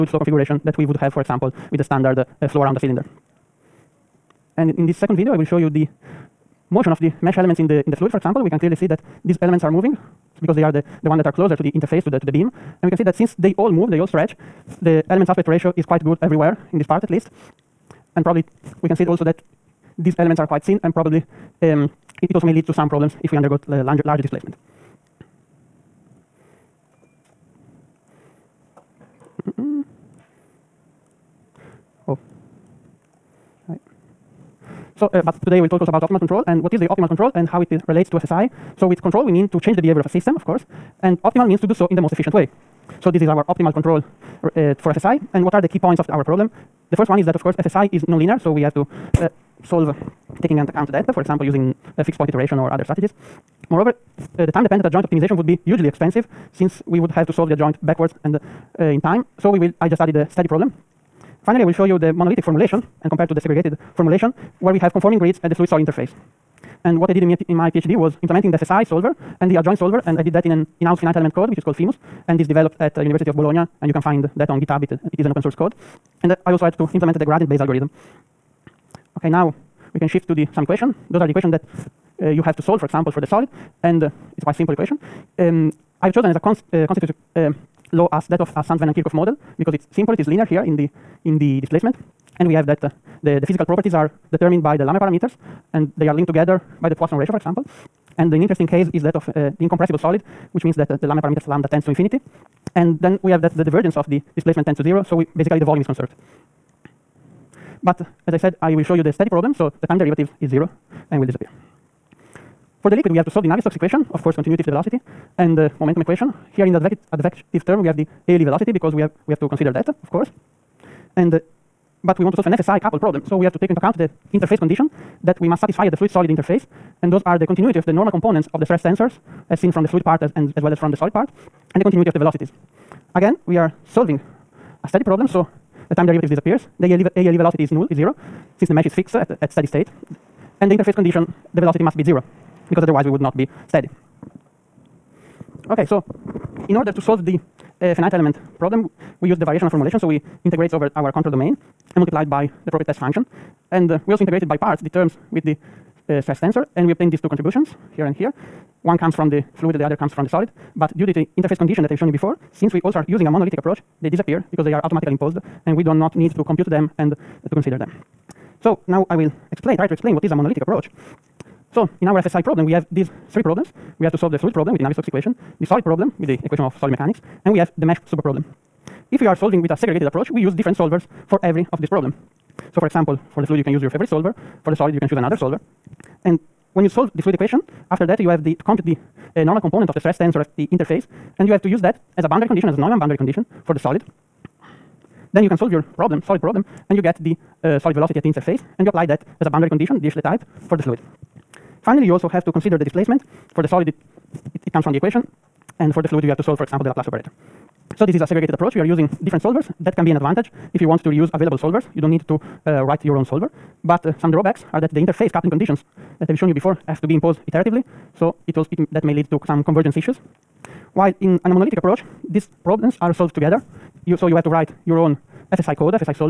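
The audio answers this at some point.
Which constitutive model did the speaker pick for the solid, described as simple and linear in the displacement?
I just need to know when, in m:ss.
1:28.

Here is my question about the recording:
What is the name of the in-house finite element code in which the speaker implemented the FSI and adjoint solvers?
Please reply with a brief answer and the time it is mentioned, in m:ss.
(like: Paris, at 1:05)
FEMuS, at 1:11.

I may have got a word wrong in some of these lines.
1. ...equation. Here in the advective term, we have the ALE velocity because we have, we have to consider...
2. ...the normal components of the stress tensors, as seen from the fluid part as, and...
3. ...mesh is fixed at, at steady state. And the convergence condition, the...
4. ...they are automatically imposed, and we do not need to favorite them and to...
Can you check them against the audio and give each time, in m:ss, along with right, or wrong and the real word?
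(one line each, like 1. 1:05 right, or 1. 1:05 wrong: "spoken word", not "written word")
1. 1:56 right
2. 2:07 right
3. 2:18 wrong: "interface", not "convergence"
4. 2:44 wrong: "compute", not "favorite".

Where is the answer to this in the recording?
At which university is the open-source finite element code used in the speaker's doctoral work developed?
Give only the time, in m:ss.
1:13.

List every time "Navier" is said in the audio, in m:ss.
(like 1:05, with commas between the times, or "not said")
1:53, 2:54.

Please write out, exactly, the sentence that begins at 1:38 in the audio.
And an interesting case is that of uh, the incompressible solid, which means that uh, the Lamé parameters lambda tends to infinity.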